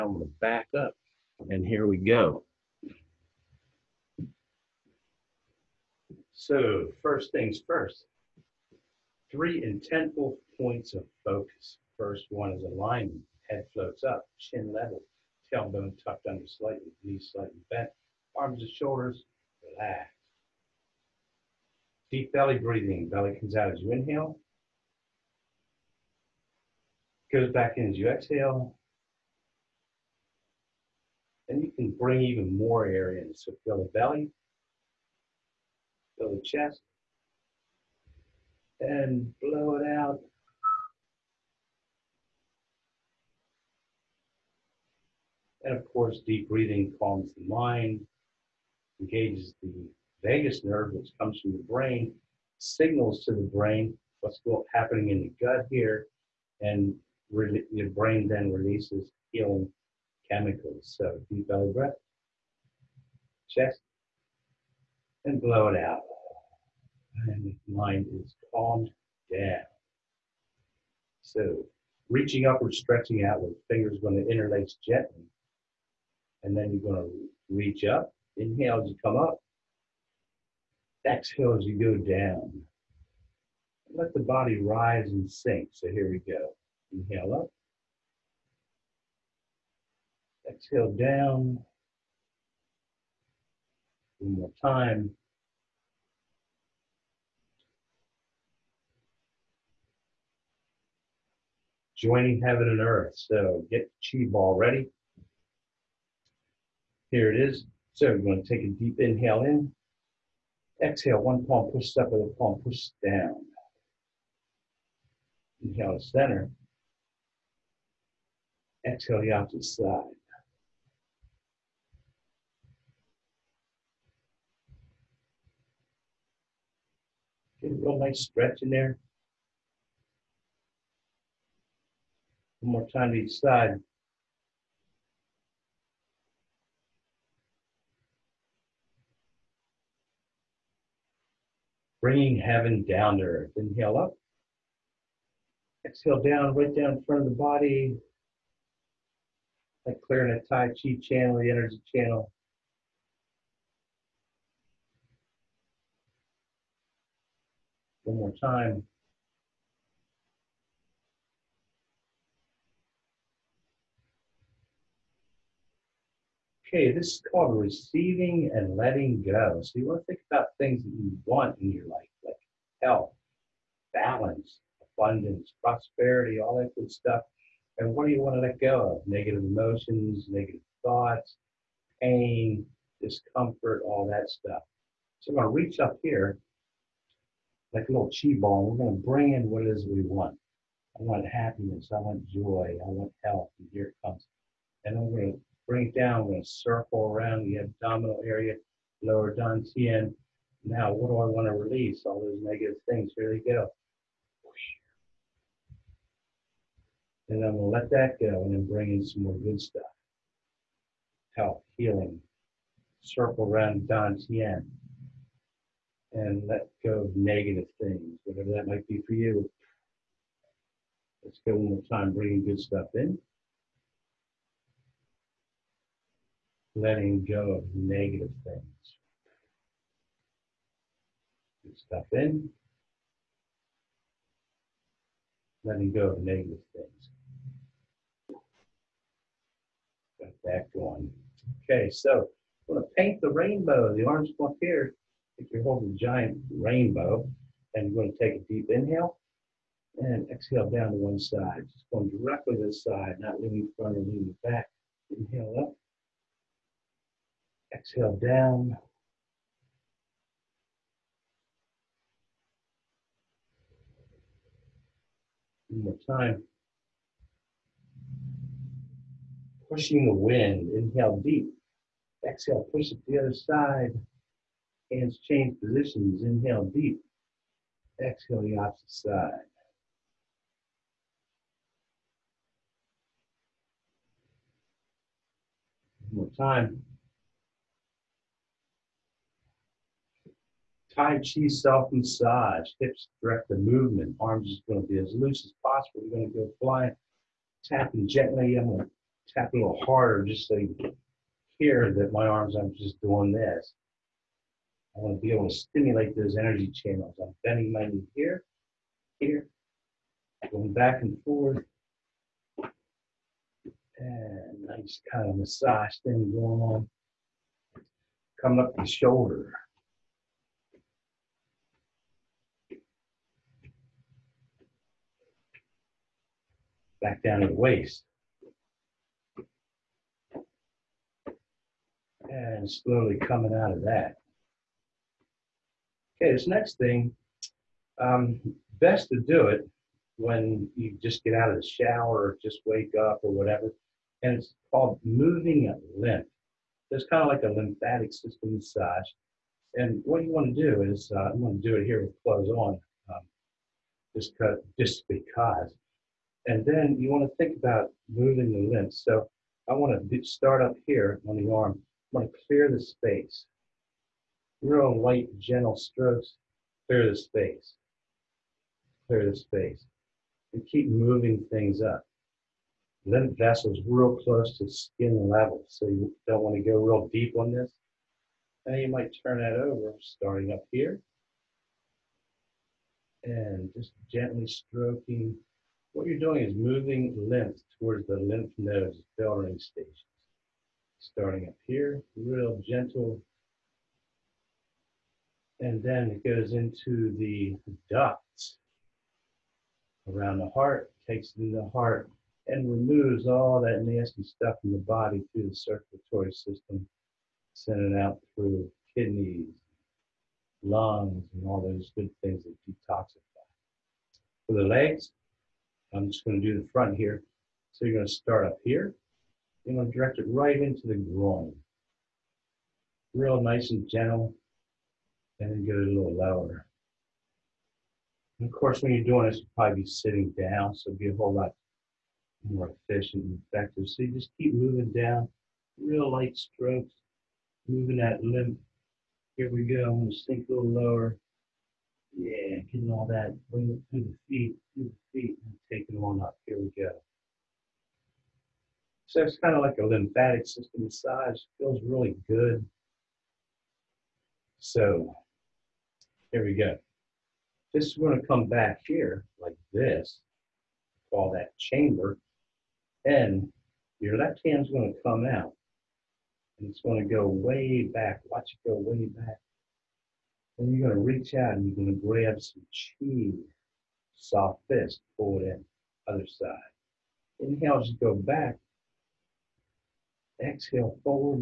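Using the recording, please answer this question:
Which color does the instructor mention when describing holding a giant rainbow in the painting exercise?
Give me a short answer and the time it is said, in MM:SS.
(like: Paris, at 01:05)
Orange, at 04:04.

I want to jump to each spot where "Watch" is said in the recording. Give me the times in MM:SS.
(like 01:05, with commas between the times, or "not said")
07:48.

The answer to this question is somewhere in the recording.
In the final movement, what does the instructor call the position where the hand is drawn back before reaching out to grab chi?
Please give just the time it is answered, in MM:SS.
07:41.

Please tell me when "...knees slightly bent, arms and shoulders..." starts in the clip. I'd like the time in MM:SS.
00:17.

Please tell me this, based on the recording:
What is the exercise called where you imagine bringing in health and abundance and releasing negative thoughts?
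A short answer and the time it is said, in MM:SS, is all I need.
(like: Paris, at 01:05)
Receiving and letting go, at 02:47.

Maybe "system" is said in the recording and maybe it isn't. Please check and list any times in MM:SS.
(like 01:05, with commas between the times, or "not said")
05:48, 06:46, 07:30.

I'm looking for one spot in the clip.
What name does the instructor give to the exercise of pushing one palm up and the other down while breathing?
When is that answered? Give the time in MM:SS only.
01:41.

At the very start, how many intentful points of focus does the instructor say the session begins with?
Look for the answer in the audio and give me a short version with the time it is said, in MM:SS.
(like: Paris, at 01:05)
3, at 00:09.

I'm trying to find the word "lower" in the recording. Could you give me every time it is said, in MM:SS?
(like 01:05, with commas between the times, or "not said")
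03:19, 07:06, 07:20.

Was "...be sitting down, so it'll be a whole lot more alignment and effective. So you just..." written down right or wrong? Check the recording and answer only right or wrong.
wrong.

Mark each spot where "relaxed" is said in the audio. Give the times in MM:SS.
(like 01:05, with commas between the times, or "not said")
00:19.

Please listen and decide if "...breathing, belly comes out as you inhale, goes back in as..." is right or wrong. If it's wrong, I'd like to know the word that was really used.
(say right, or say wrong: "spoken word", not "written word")
right.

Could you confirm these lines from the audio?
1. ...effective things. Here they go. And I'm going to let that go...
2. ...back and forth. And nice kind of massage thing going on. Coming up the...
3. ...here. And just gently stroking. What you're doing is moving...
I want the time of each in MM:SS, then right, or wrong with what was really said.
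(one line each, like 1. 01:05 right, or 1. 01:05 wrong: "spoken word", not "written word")
1. 03:22 wrong: "negative", not "effective"
2. 05:10 right
3. 06:20 right.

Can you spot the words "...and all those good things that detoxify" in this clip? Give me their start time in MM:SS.
06:51.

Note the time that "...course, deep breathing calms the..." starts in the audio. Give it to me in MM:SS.
00:45.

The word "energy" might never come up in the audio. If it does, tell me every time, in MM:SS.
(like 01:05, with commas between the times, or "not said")
02:31, 05:06.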